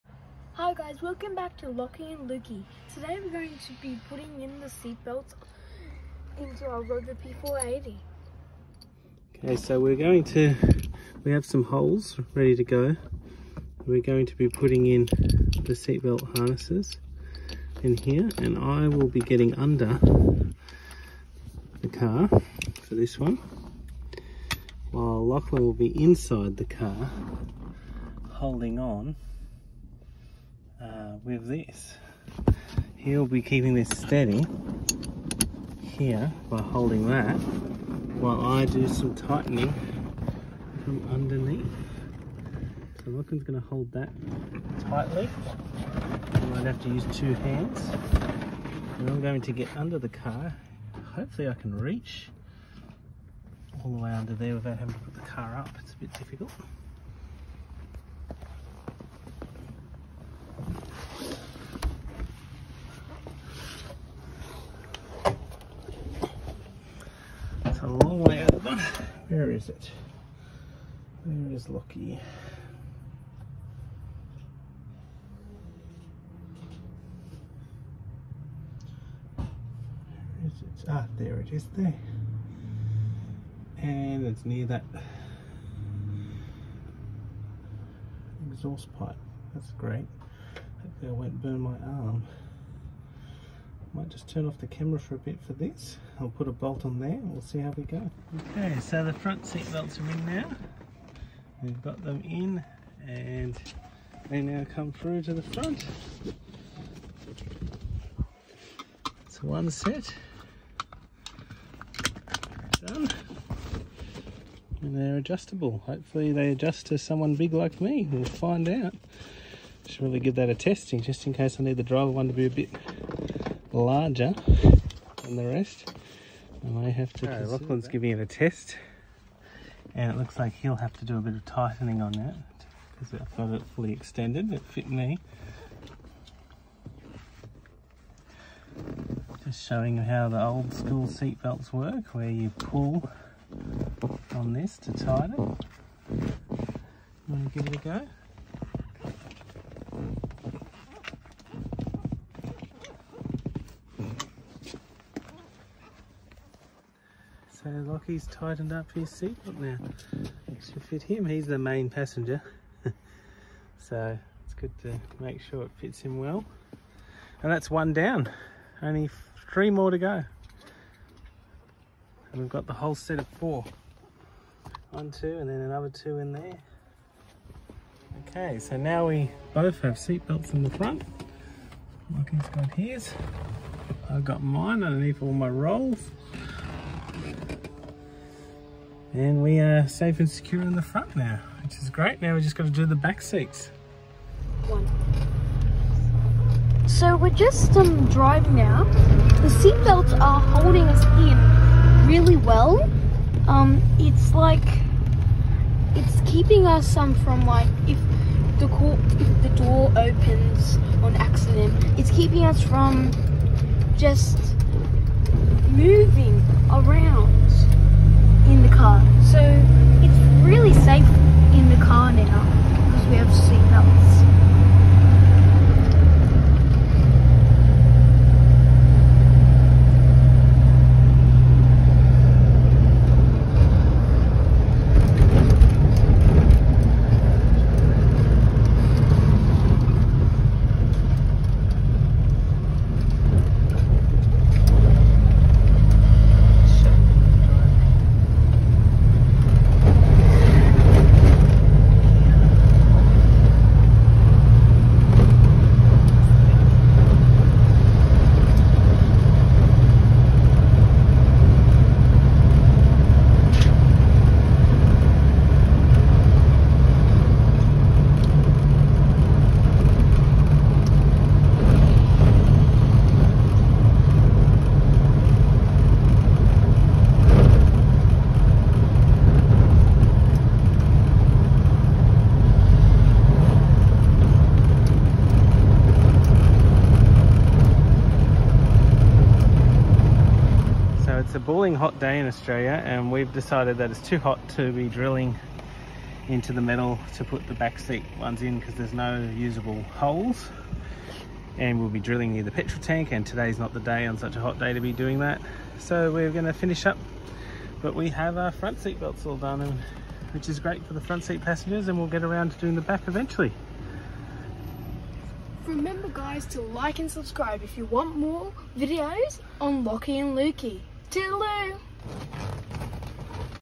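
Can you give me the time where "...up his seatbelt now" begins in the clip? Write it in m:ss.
2:38.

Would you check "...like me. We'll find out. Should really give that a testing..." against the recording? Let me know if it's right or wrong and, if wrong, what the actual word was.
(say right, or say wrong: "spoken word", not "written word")
right.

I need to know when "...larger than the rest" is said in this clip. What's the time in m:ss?
2:03.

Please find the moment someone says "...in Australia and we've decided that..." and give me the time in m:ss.
4:52.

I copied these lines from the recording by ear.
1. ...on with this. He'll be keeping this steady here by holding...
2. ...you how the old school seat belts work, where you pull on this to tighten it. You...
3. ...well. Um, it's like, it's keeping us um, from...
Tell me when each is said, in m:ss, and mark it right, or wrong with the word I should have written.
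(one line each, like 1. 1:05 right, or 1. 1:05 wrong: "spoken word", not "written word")
1. 0:28 right
2. 2:19 right
3. 3:22 right.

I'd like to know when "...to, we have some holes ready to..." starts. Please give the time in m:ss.
0:10.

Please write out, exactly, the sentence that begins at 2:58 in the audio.
Okay, so now we both have seatbelts in the front.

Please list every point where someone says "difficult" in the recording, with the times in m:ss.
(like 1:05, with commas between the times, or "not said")
0:56.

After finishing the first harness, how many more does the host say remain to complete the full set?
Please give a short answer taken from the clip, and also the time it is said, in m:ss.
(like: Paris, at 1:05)
3, at 2:49.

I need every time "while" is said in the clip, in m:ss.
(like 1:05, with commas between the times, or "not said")
0:24, 0:38.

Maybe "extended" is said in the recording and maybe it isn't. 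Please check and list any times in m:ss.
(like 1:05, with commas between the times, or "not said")
2:13.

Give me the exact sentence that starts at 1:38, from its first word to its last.
Okay, so the front seat belts are in now.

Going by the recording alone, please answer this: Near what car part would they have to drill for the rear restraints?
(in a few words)
petrol tank.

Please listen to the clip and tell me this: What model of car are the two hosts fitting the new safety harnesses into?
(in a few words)
Rover P4 80.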